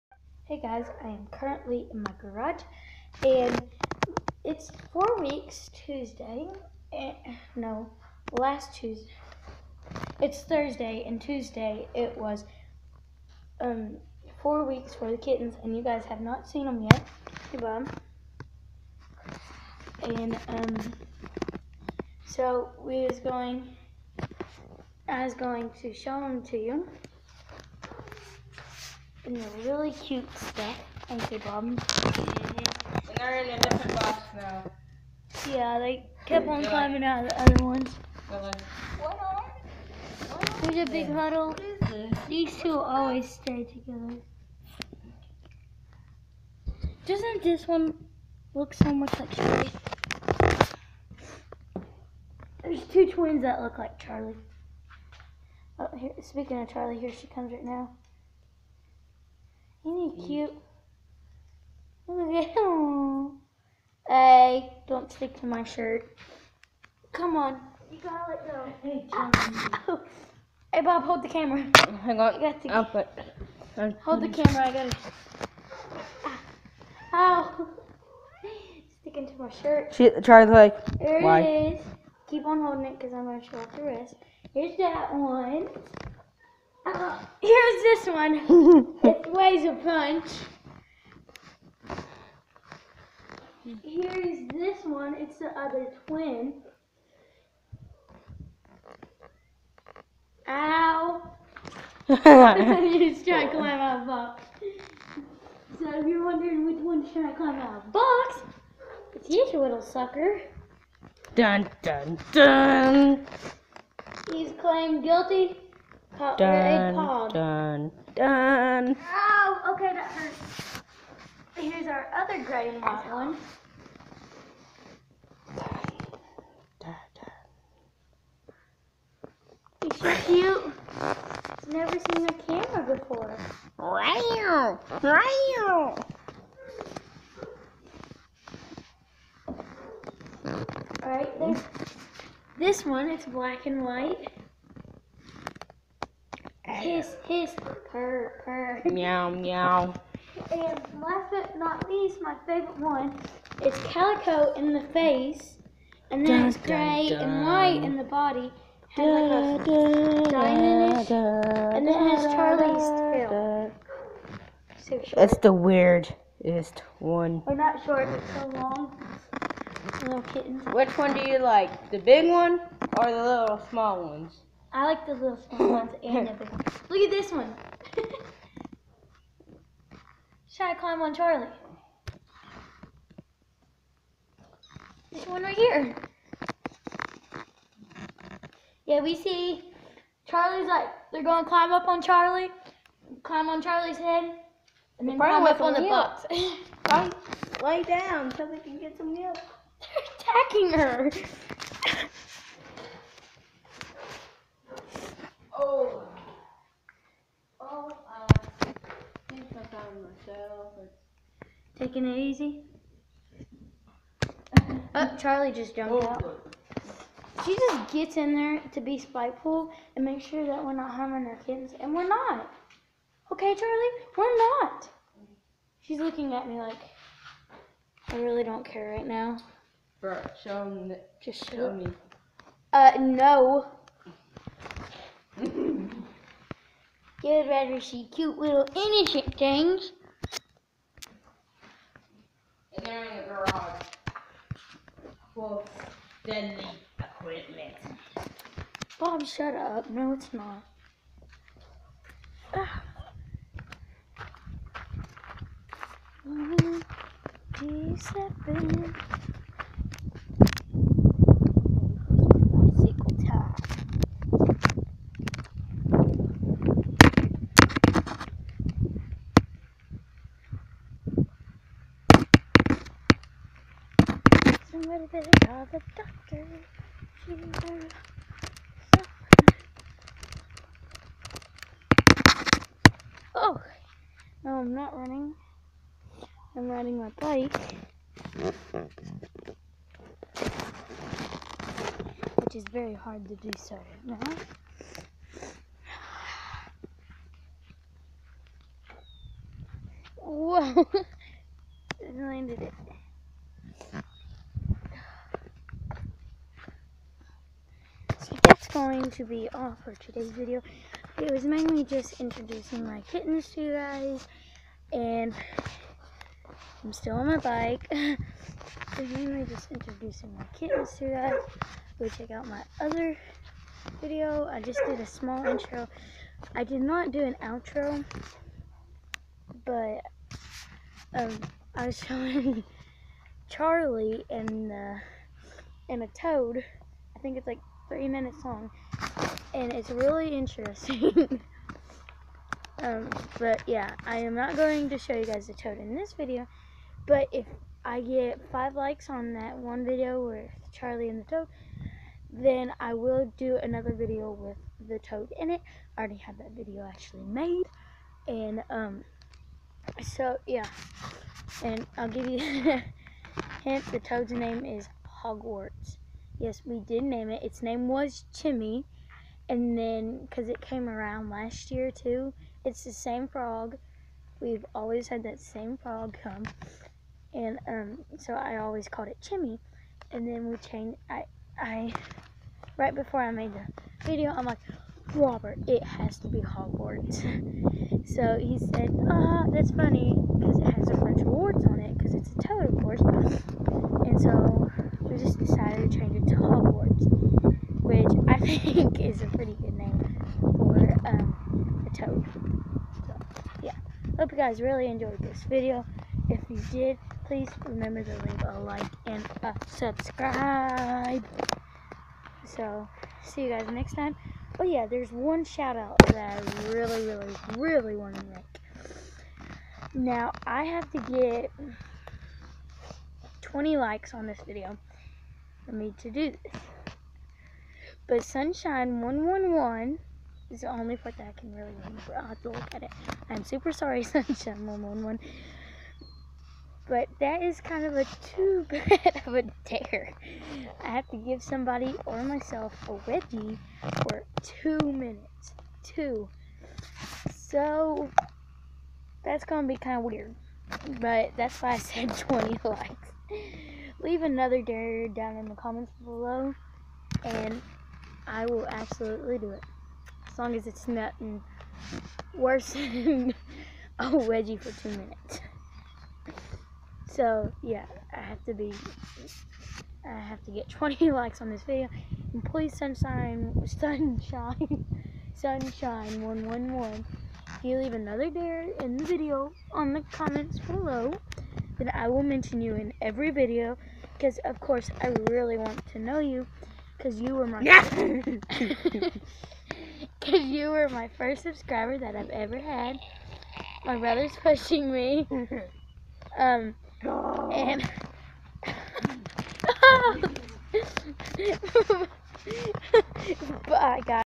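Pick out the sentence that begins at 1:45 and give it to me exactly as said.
So if you're wondering which one's trying to climb out of the box, it's you, little sucker.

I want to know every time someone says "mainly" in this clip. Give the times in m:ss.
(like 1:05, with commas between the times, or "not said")
5:11, 5:19.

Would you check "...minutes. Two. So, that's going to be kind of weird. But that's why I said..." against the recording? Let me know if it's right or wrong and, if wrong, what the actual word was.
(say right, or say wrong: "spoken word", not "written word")
right.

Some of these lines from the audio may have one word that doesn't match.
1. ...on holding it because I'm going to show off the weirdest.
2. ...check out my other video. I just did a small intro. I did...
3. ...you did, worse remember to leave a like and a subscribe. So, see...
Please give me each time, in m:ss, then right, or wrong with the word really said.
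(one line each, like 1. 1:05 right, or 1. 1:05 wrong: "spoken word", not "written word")
1. 1:22 wrong: "wrist", not "weirdest"
2. 5:22 right
3. 6:46 wrong: "please", not "worse".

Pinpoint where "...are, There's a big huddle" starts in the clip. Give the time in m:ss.
0:39.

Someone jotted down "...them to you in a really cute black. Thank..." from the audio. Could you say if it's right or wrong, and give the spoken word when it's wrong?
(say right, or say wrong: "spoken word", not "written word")
wrong: "stick", not "black".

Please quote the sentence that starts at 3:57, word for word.
Get ready, she cute little innocent things.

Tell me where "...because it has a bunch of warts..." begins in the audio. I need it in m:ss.
6:30.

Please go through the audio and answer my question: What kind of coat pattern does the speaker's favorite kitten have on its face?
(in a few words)
calico.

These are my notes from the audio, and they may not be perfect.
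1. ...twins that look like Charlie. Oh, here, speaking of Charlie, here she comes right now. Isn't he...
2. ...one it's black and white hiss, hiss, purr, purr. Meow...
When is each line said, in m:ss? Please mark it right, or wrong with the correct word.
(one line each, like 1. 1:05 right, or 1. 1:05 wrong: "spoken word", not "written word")
1. 0:53 right
2. 2:22 right.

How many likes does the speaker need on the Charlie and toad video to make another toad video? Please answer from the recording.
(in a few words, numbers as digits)
5.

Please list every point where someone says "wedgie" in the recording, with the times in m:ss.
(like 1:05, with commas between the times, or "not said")
7:23, 7:44.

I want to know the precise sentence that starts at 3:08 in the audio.
Yeah, we see Charlie's like, they're going to climb up on Charlie, climb on Charlie's head, and then climb up on milk.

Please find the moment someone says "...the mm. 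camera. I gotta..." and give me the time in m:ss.
1:14.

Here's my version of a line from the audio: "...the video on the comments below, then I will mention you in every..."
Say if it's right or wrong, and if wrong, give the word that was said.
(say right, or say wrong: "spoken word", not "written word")
right.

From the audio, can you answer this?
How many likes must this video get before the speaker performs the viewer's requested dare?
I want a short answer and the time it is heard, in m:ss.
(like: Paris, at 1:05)
20, at 7:03.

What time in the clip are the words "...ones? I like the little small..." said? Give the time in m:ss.
2:54.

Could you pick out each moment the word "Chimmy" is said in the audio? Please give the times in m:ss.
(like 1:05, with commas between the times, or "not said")
6:08, 6:19.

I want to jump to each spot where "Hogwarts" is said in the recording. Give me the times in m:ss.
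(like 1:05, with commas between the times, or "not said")
6:05, 6:26, 6:36.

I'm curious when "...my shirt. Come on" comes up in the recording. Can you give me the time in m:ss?
1:05.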